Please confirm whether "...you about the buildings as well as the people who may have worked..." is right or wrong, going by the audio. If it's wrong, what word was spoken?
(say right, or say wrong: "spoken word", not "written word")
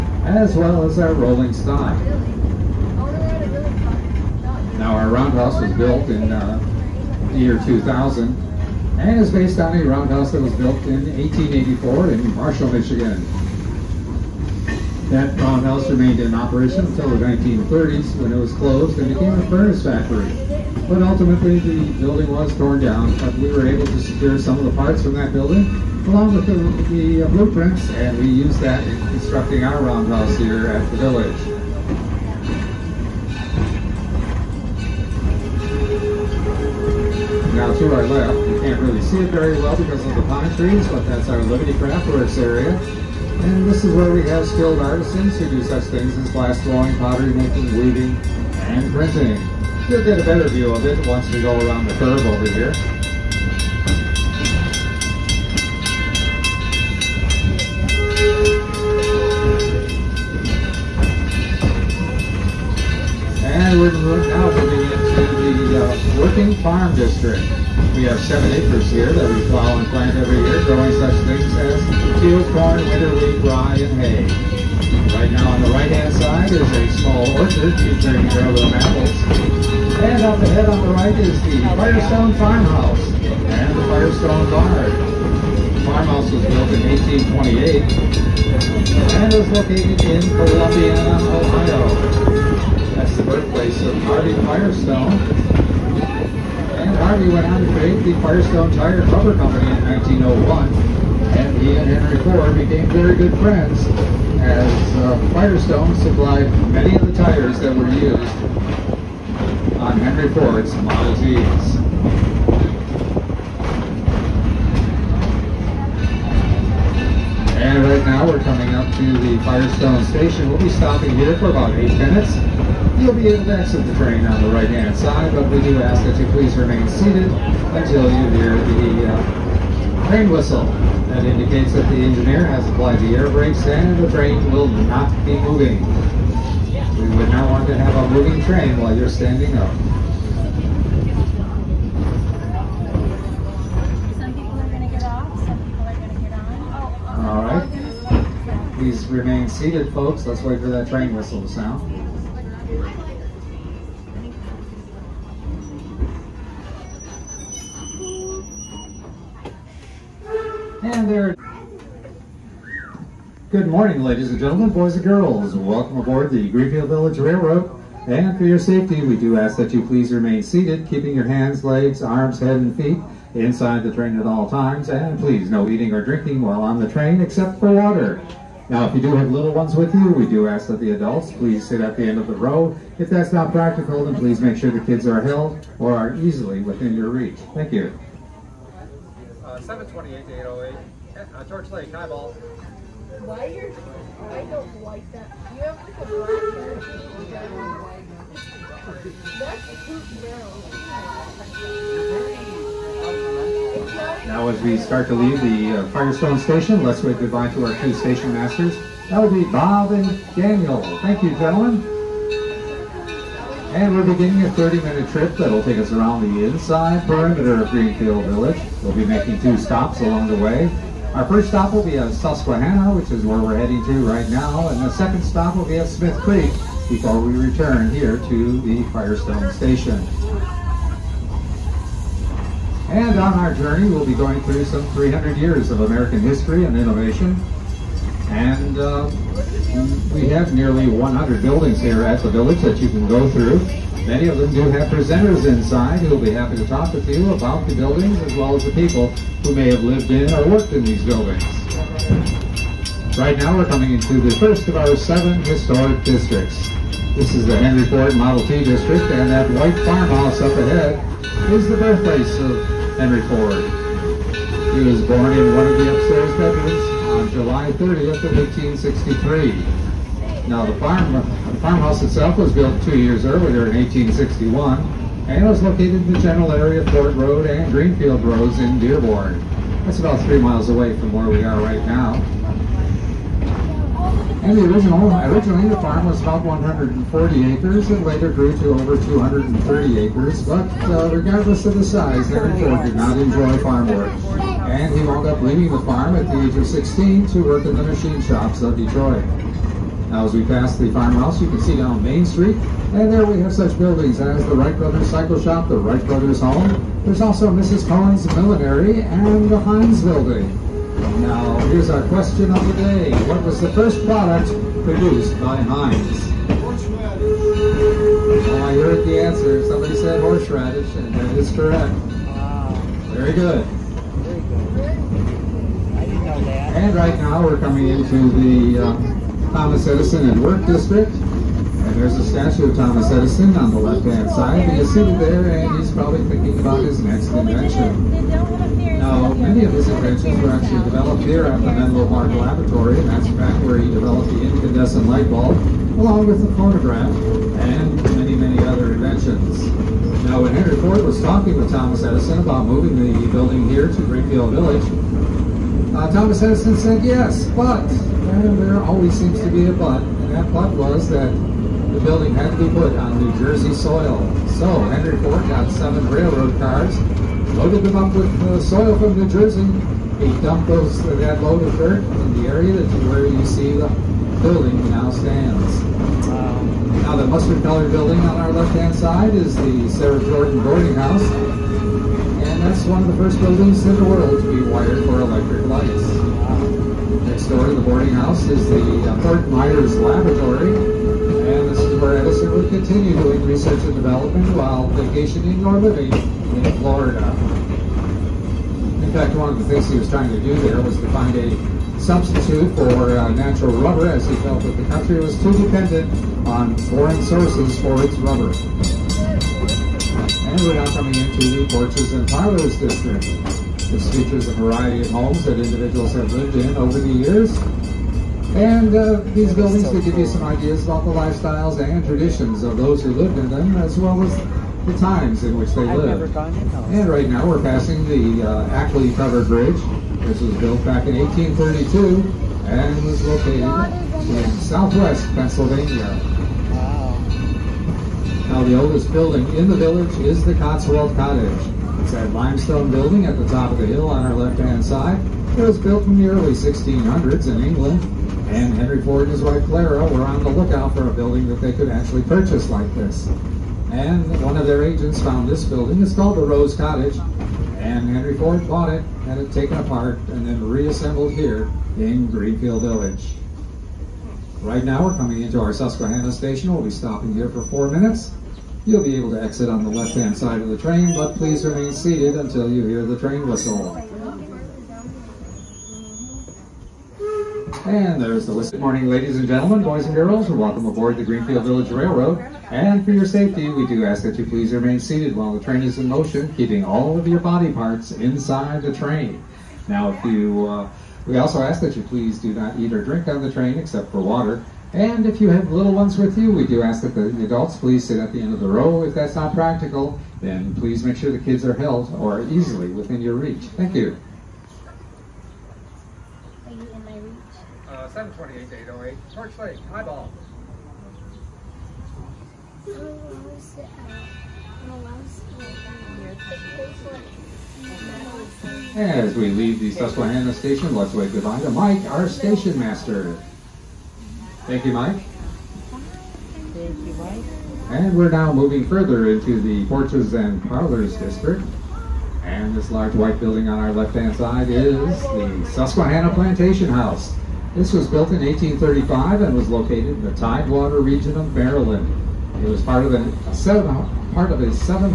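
wrong: "lived", not "worked".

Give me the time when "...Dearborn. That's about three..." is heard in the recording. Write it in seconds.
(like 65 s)
278 s.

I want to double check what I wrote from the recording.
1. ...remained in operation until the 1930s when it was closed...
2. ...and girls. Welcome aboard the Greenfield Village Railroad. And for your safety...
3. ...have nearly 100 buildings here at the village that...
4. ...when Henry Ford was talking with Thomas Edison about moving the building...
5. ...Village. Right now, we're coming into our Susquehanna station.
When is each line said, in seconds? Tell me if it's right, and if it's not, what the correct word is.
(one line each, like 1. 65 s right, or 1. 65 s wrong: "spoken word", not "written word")
1. 15 s right
2. 164 s right
3. 240 s right
4. 350 s right
5. 462 s right.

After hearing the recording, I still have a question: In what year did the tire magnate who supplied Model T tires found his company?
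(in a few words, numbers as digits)
1901.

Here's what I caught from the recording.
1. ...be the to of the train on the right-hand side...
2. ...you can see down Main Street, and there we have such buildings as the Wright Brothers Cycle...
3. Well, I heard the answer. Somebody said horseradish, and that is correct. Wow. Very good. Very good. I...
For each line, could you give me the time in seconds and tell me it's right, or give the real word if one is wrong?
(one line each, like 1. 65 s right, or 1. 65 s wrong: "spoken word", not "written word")
1. 123 s right
2. 301 s right
3. 316 s right.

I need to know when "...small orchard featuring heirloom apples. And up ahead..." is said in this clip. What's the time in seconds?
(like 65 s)
76 s.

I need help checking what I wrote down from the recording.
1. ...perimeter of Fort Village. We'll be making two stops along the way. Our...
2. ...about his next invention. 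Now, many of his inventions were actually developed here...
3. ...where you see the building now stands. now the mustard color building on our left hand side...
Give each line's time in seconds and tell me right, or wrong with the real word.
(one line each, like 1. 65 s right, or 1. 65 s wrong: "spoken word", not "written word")
1. 217 s wrong: "Greenfield", not "Fort"
2. 336 s right
3. 373 s right.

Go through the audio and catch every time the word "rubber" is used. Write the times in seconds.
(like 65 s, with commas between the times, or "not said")
99 s, 403 s, 408 s.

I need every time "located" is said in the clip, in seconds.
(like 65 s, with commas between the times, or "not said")
89 s, 275 s, 433 s, 539 s.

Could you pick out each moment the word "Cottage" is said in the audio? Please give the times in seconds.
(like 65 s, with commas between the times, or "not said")
441 s, 456 s.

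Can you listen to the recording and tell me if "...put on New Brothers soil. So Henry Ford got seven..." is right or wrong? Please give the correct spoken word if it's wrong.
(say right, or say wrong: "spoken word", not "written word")
wrong: "Jersey", not "Brothers".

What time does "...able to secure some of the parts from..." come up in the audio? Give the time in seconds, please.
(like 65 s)
23 s.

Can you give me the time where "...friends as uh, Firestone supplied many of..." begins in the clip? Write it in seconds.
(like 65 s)
103 s.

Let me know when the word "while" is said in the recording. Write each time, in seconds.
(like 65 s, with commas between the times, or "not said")
138 s, 176 s, 394 s, 485 s.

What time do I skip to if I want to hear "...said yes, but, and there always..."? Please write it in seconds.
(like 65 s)
356 s.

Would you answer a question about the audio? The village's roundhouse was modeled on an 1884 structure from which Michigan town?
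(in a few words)
Marshall, Michigan.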